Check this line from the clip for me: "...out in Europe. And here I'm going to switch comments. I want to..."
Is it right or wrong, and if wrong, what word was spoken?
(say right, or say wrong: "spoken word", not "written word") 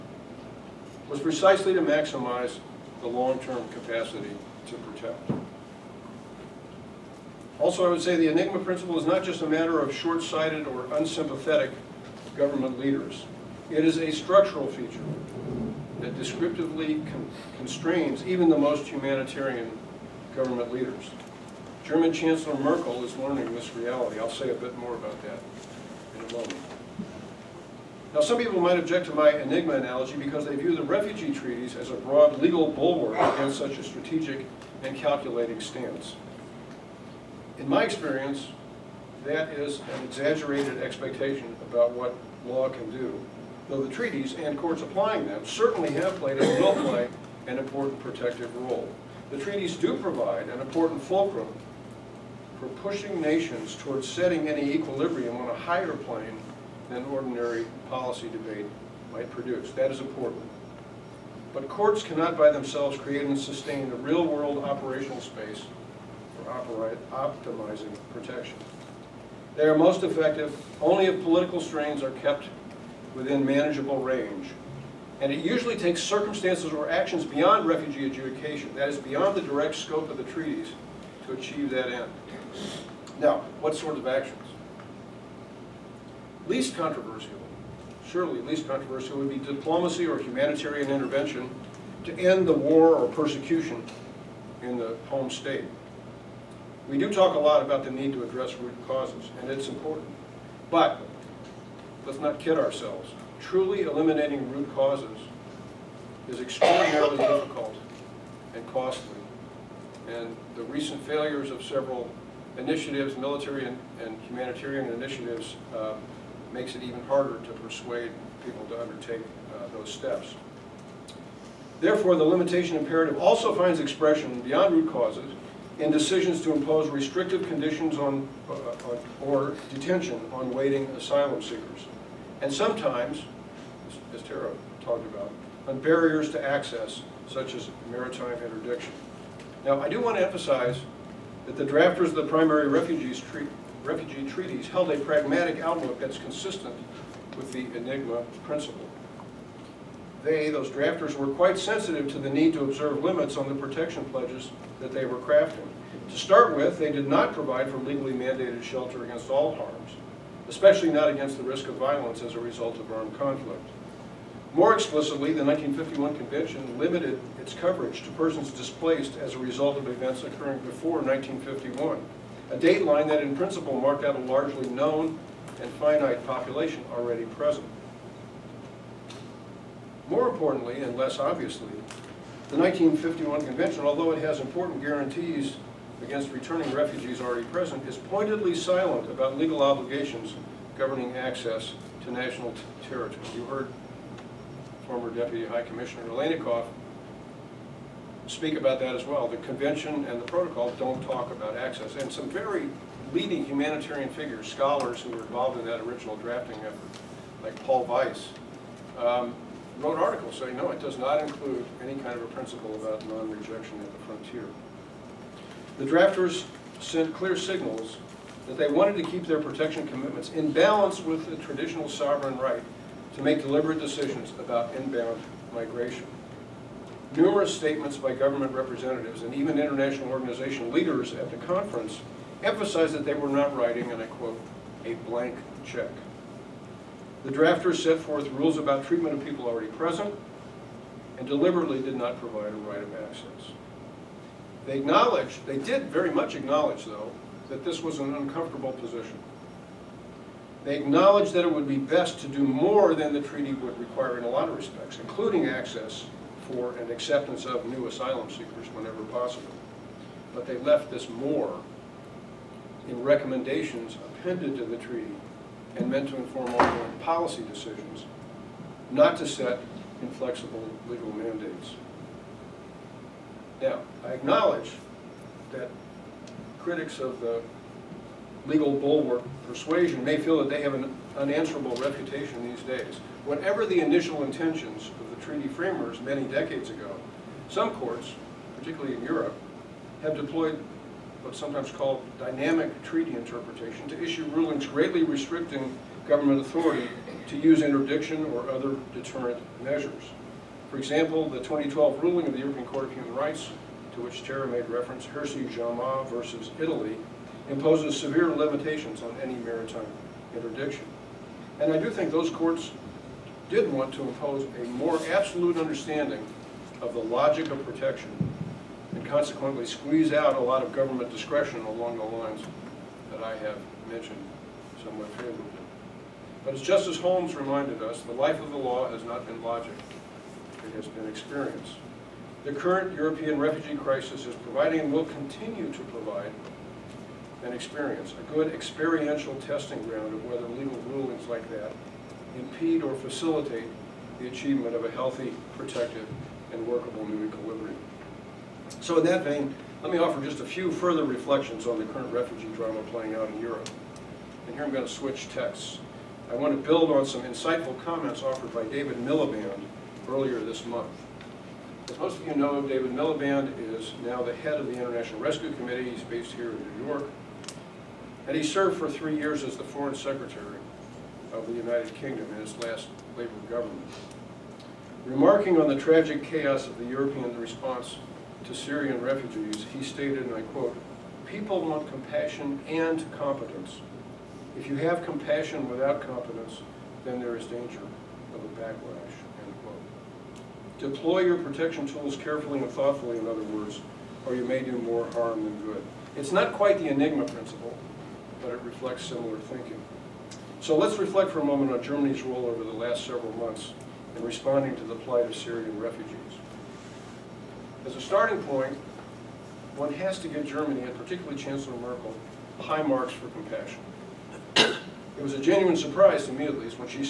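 wrong: "texts", not "comments".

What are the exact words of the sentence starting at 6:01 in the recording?
As most of you know, David Miliband is now the head of the International Rescue Committee.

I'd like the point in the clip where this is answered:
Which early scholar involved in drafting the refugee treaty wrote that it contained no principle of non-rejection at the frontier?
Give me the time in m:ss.
3:27.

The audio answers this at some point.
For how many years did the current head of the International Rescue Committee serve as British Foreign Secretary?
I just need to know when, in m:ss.
6:08.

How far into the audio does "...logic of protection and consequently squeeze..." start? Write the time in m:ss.
5:16.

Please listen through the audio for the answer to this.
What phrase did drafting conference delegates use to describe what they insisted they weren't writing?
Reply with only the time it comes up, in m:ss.
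3:54.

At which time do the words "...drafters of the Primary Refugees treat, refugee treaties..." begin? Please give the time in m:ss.
2:21.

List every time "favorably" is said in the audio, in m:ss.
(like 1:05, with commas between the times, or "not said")
5:25.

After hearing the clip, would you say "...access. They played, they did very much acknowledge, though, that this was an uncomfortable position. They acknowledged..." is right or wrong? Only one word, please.
wrong.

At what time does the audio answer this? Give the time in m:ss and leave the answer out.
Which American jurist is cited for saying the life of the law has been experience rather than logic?
5:26.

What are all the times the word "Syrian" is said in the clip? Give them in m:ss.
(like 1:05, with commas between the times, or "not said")
6:18, 6:45.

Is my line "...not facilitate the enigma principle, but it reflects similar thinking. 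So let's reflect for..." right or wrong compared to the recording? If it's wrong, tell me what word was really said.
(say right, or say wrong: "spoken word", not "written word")
wrong: "quite", not "facilitate".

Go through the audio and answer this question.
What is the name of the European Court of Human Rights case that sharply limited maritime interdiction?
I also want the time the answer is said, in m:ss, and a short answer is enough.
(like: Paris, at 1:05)
Hirsi Jamaa versus Italy, at 5:05.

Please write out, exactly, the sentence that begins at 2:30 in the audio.
They, those drafters, were quite sensitive to the need to observe limits on the protection pledges that they were crafting.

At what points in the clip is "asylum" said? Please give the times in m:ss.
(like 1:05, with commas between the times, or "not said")
2:10, 4:17.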